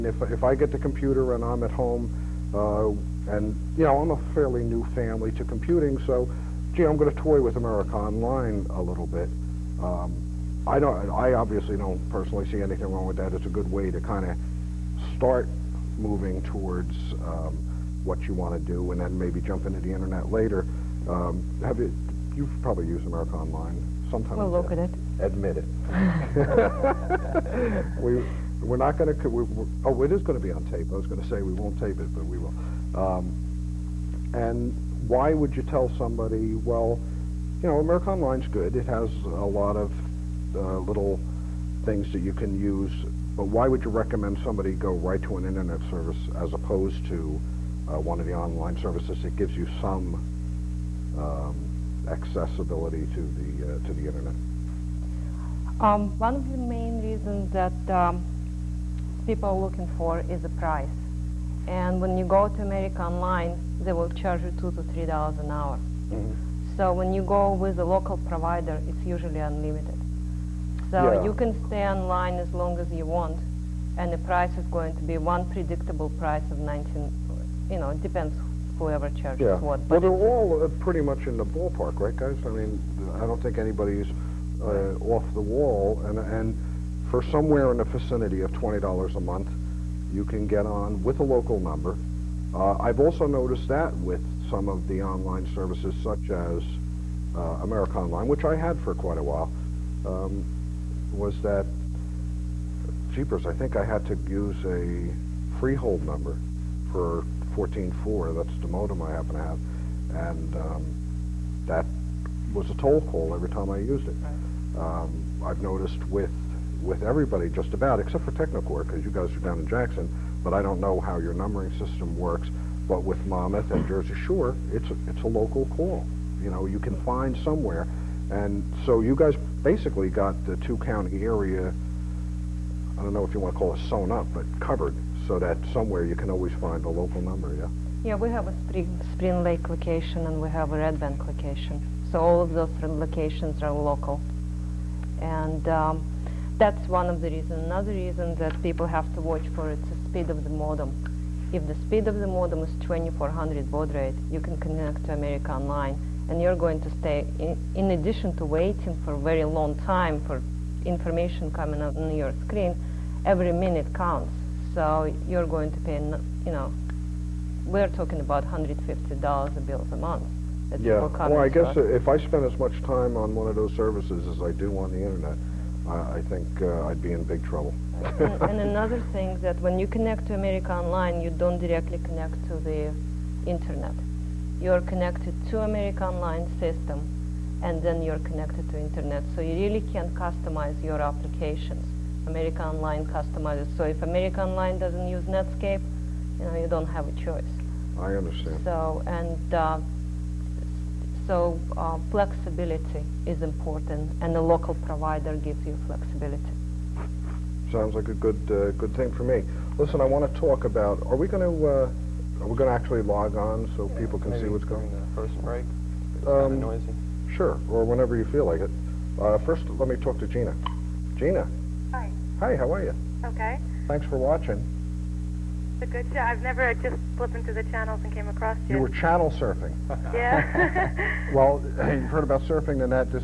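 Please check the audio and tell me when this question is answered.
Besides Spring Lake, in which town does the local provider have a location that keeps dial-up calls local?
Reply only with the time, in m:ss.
2:20.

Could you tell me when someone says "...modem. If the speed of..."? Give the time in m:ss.
2:30.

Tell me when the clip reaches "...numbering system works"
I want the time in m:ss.
2:01.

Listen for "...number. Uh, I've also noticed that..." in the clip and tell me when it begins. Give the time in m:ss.
1:31.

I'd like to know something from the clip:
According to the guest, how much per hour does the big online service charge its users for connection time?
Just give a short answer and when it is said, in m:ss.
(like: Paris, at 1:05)
2 to 3 dollars, at 1:04.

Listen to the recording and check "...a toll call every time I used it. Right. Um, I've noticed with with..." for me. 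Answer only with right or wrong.
right.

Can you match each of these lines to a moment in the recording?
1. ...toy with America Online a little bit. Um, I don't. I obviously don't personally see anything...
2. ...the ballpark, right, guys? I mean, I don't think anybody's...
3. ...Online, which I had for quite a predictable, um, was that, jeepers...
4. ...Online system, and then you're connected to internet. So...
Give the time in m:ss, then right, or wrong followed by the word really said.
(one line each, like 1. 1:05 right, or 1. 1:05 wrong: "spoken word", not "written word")
1. 0:07 right
2. 1:21 right
3. 1:37 wrong: "while", not "predictable"
4. 3:06 right.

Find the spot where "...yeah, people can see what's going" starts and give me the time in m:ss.
3:33.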